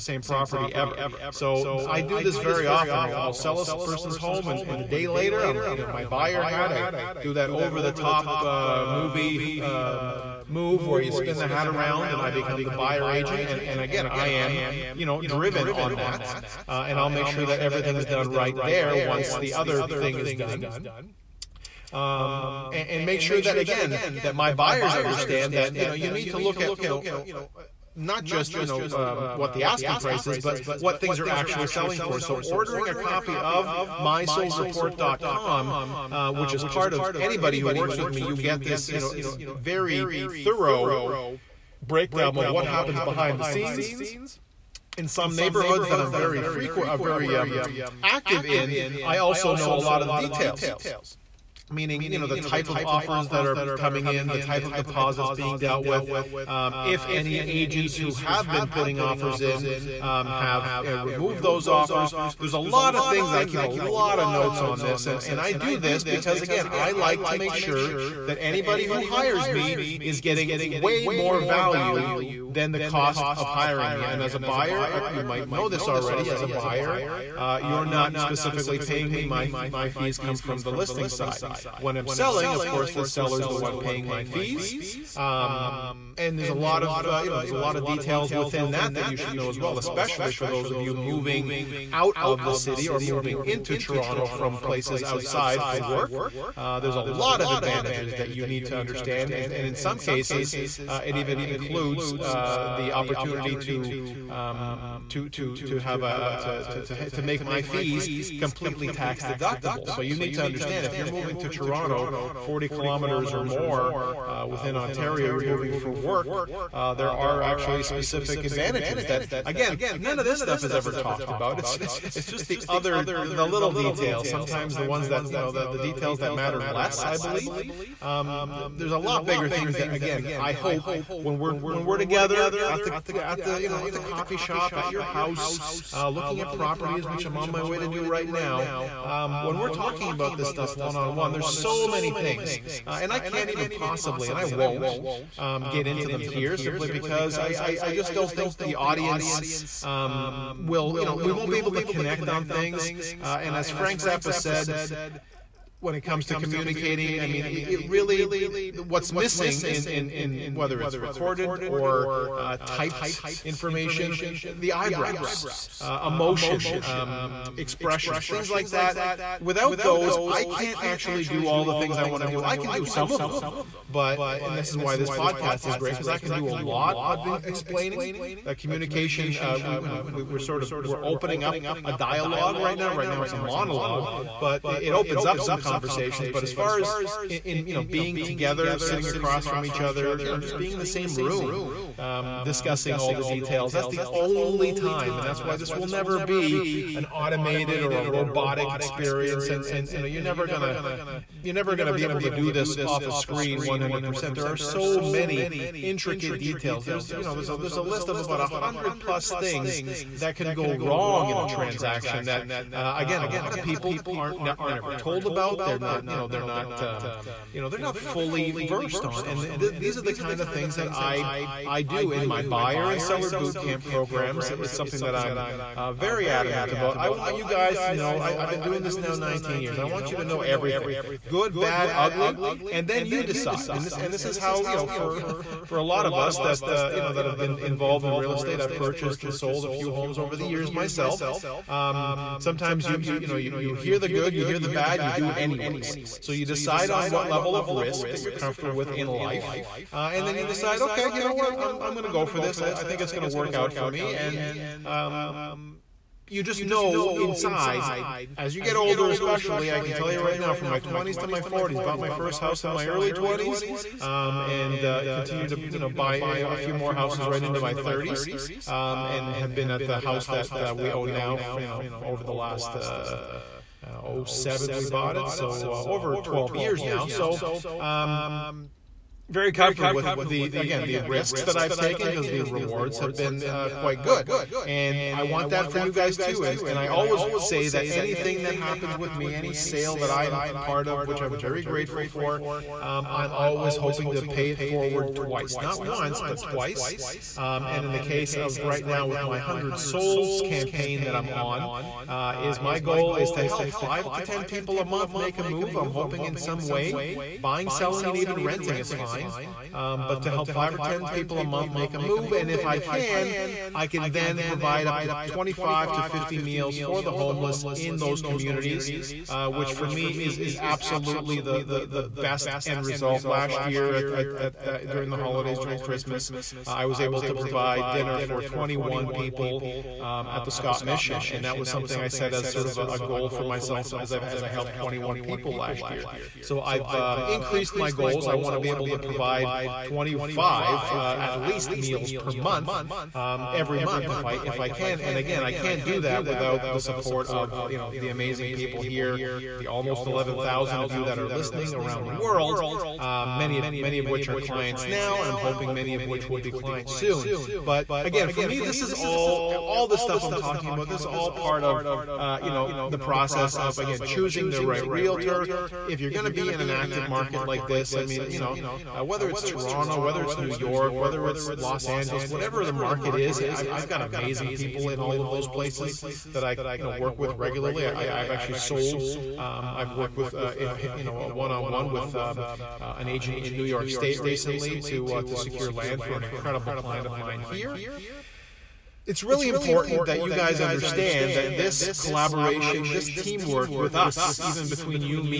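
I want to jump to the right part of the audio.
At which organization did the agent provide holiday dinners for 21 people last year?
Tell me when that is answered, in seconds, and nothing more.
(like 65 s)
330 s.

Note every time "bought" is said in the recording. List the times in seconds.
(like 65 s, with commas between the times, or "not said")
261 s, 274 s.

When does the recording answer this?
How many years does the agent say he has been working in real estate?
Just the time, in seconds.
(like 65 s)
229 s.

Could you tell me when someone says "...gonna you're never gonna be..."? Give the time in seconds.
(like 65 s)
200 s.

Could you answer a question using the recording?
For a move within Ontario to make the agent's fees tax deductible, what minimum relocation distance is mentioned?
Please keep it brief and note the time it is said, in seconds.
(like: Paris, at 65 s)
40 kilometers, at 112 s.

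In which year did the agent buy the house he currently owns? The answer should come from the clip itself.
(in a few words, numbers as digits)
2007.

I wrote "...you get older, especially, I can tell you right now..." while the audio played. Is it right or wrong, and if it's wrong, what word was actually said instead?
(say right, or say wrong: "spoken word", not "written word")
right.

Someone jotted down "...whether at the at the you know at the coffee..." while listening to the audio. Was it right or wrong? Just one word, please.
wrong.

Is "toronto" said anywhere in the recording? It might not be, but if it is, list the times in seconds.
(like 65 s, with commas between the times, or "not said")
93 s, 111 s, 369 s.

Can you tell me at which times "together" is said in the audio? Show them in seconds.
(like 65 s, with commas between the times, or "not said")
131 s, 188 s.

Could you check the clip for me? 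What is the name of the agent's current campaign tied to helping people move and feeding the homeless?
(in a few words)
100 souls campaign.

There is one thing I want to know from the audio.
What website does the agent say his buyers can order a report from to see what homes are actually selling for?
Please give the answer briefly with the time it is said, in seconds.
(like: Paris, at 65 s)
mysoldreport.com, at 33 s.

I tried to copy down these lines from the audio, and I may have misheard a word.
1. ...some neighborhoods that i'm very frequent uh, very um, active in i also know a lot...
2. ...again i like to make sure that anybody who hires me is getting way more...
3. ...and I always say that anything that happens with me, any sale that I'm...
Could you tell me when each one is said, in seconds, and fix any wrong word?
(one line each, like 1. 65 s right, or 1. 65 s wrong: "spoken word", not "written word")
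1. 45 s right
2. 66 s right
3. 286 s right.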